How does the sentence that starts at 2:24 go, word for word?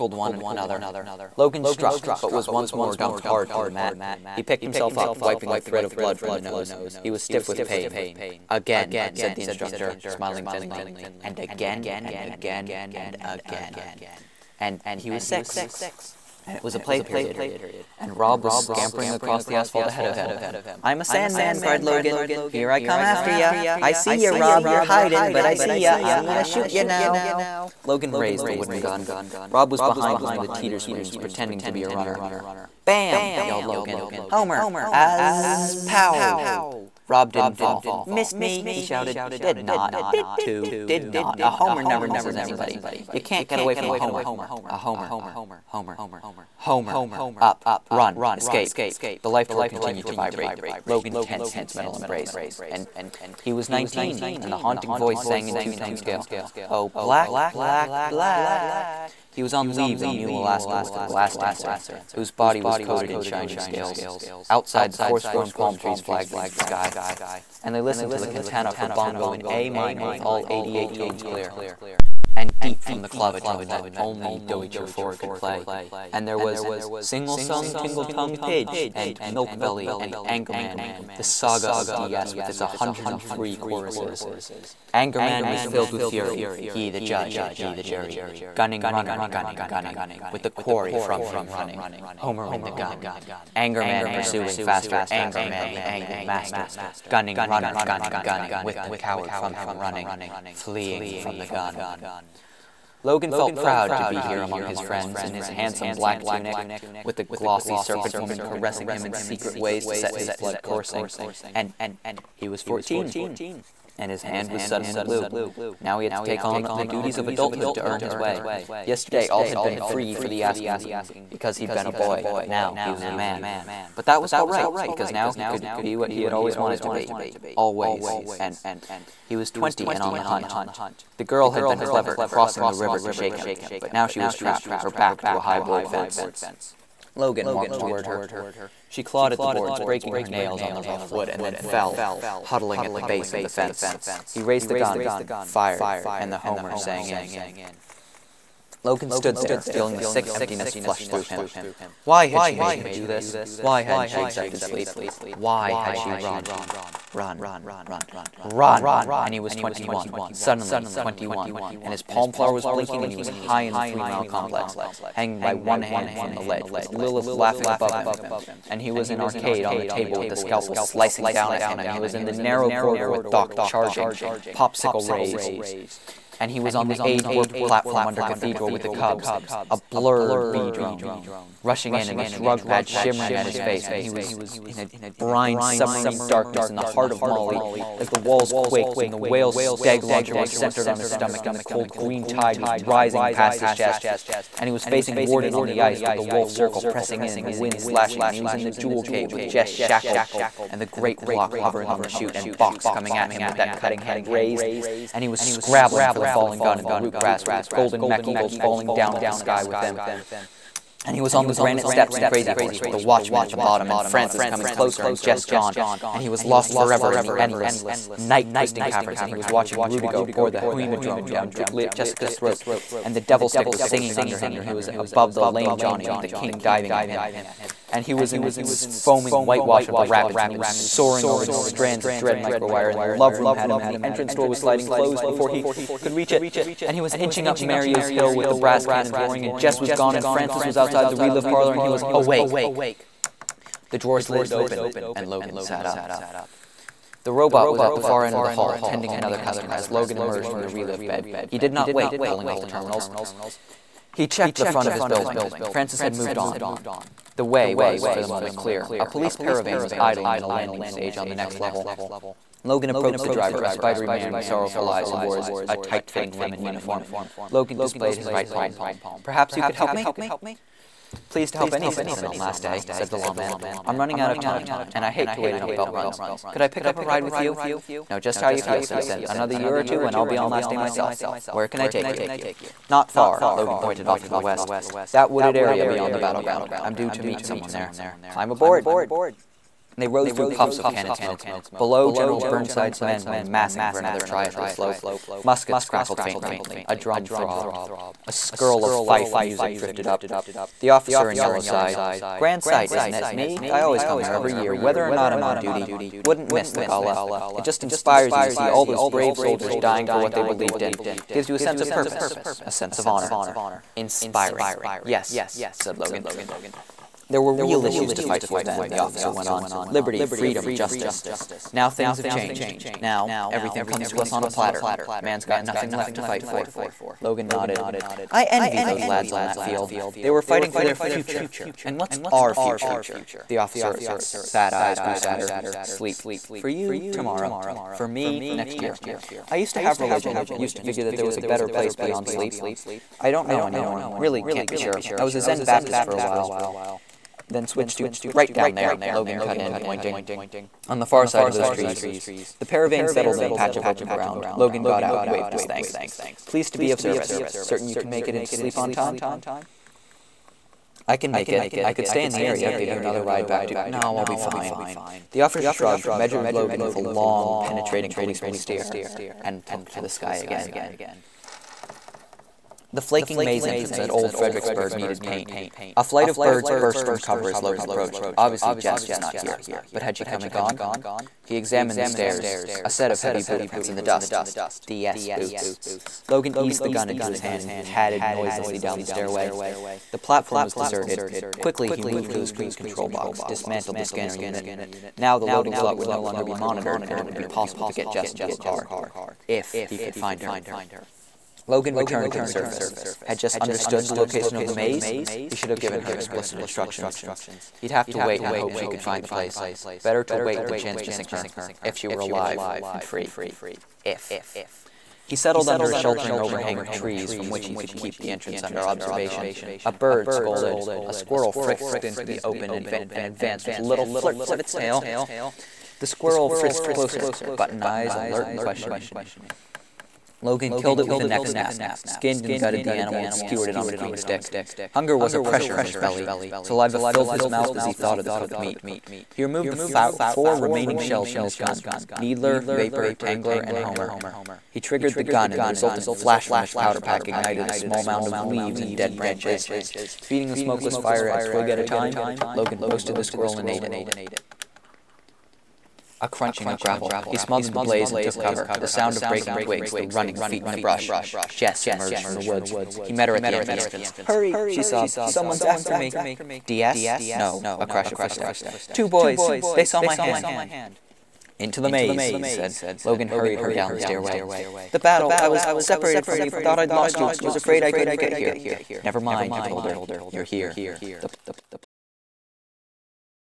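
He raised the gun, fired, and the homer sang in.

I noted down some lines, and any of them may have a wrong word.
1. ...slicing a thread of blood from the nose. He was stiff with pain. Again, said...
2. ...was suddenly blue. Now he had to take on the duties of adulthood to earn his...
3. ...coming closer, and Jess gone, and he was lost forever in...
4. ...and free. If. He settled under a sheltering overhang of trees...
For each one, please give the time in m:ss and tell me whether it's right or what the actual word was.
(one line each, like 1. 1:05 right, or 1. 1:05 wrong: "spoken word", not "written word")
1. 0:05 wrong: "wiping", not "slicing"
2. 1:54 right
3. 3:34 right
4. 6:52 right.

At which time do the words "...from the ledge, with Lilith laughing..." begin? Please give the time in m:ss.
2:46.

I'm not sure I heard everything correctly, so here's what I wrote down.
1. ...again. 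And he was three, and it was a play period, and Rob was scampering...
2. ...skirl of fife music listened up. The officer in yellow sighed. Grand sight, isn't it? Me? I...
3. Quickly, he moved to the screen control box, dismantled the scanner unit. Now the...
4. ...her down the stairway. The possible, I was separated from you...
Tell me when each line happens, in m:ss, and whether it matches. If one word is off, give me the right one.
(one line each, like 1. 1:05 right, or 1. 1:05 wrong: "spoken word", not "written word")
1. 0:13 wrong: "six", not "three"
2. 4:58 wrong: "drifted", not "listened"
3. 6:31 right
4. 7:53 wrong: "battle", not "possible".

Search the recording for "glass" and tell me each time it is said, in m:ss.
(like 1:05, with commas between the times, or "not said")
1:00.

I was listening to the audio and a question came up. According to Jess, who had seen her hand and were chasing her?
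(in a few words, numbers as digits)
2 boys.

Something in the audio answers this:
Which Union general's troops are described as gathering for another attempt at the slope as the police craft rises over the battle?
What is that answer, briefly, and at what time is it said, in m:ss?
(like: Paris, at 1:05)
General Burnside, at 4:52.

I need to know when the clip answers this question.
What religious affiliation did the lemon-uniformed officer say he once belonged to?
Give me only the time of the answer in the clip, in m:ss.
5:45.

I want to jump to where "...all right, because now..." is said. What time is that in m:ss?
2:04.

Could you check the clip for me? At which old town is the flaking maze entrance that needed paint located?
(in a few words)
Old Fredericksburg.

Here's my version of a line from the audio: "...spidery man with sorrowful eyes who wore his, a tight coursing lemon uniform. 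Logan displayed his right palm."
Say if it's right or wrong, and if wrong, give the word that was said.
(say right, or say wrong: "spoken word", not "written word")
wrong: "fitting", not "coursing".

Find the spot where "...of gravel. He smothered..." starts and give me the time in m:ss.
7:36.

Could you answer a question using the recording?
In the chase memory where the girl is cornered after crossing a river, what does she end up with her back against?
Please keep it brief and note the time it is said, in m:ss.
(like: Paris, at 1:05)
high board fence, at 2:15.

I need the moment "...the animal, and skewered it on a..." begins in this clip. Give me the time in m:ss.
7:12.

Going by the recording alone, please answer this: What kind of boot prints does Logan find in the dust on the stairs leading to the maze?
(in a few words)
DS boots.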